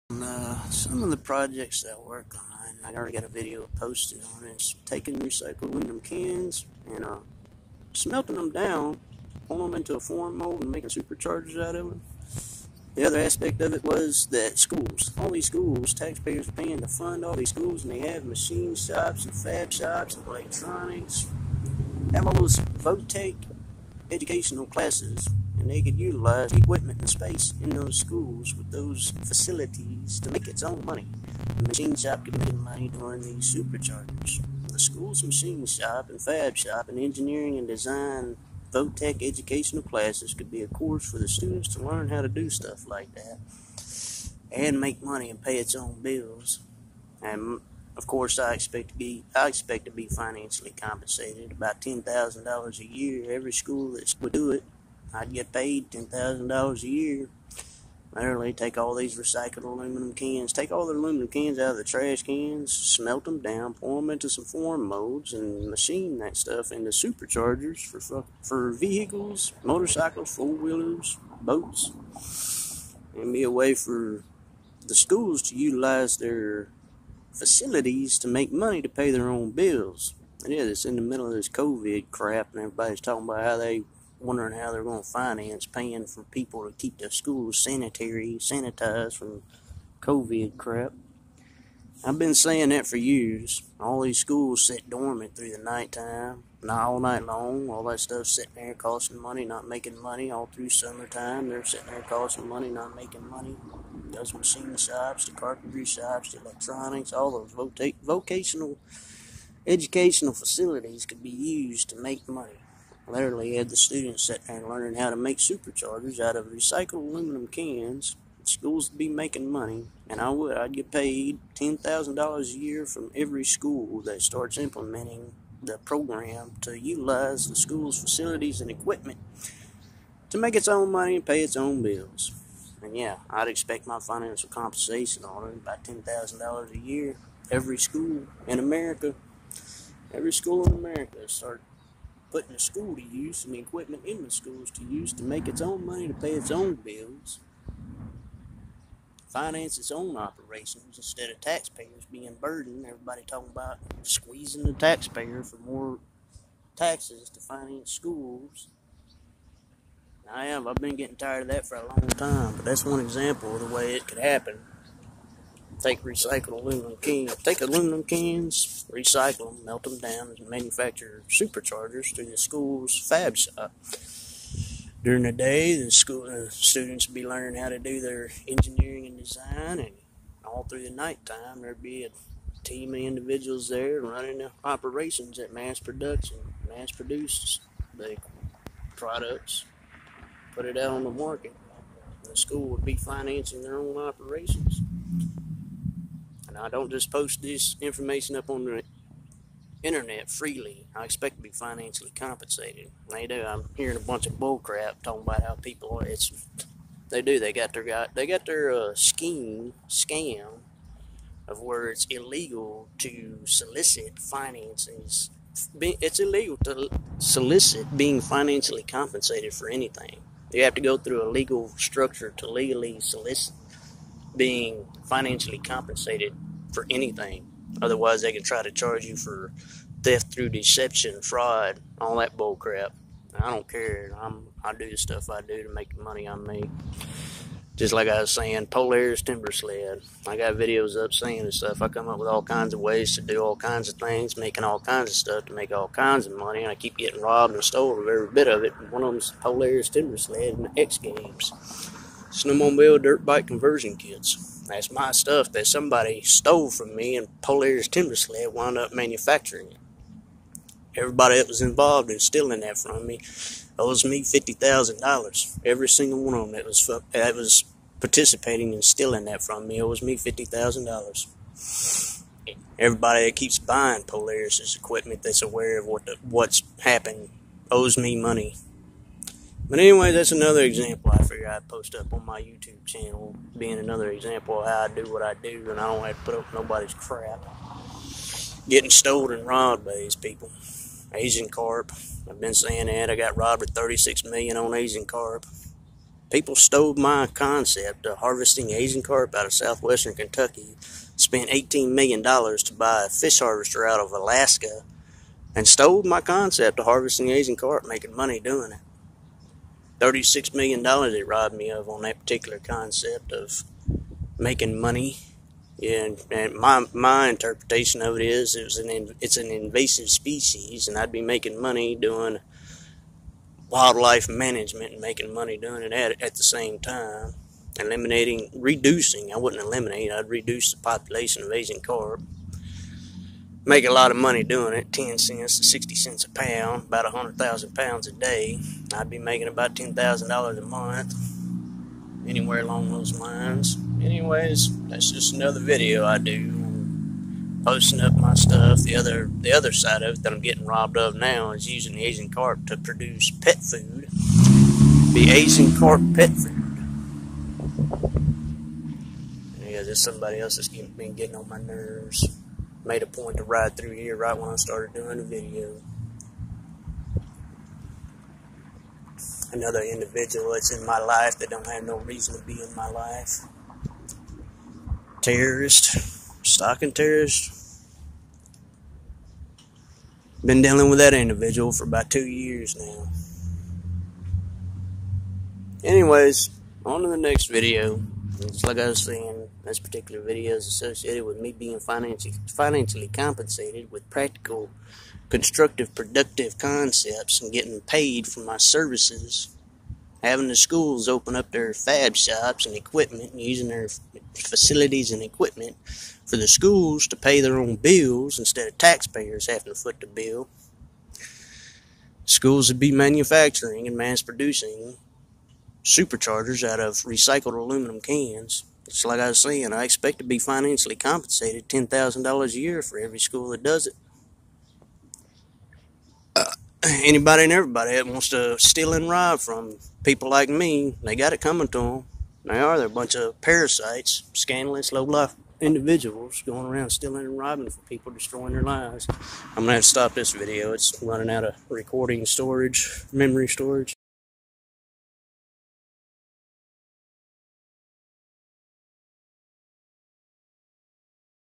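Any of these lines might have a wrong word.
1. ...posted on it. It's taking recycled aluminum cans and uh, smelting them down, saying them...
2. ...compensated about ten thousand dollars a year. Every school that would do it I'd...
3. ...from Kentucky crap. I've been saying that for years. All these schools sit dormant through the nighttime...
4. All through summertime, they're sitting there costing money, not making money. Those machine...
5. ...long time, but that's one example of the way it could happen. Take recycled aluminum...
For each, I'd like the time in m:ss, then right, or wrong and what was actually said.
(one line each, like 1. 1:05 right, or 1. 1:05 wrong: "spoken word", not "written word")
1. 0:03 wrong: "pulling", not "saying"
2. 0:50 right
3. 1:29 wrong: "COVID", not "Kentucky"
4. 1:40 right
5. 2:41 right.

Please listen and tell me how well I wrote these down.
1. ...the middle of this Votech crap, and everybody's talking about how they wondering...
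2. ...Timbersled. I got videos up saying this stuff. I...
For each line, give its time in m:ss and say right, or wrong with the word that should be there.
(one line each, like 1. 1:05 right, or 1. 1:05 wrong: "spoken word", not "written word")
1. 1:20 wrong: "COVID", not "Votech"
2. 3:59 right.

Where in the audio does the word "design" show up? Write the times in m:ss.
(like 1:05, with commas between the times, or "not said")
0:37, 2:59.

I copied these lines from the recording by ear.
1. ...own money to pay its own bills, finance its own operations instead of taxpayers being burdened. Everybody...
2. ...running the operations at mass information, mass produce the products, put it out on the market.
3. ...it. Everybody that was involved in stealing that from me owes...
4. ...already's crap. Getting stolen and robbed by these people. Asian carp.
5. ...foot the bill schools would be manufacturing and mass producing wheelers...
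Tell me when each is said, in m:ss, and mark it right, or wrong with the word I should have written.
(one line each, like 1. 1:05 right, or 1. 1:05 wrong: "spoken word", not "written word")
1. 2:25 right
2. 3:04 wrong: "production", not "information"
3. 4:19 right
4. 4:46 wrong: "nobody", not "already"
5. 6:49 wrong: "superchargers", not "wheelers".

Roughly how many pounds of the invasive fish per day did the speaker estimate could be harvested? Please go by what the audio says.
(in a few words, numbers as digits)
100,000 pounds.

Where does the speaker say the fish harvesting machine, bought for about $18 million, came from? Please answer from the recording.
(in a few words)
Alaska.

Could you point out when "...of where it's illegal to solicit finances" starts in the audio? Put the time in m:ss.
3:31.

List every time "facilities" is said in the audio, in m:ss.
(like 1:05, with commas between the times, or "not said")
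0:29, 1:17, 1:50, 2:08, 6:44.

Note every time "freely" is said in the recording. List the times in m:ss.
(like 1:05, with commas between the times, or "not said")
3:20.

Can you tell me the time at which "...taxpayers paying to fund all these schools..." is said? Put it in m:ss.
0:15.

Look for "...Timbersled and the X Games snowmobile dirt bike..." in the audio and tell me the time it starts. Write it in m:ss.
4:09.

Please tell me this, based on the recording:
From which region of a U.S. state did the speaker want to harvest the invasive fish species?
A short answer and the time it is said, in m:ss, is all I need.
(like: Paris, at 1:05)
southwestern Kentucky, at 4:59.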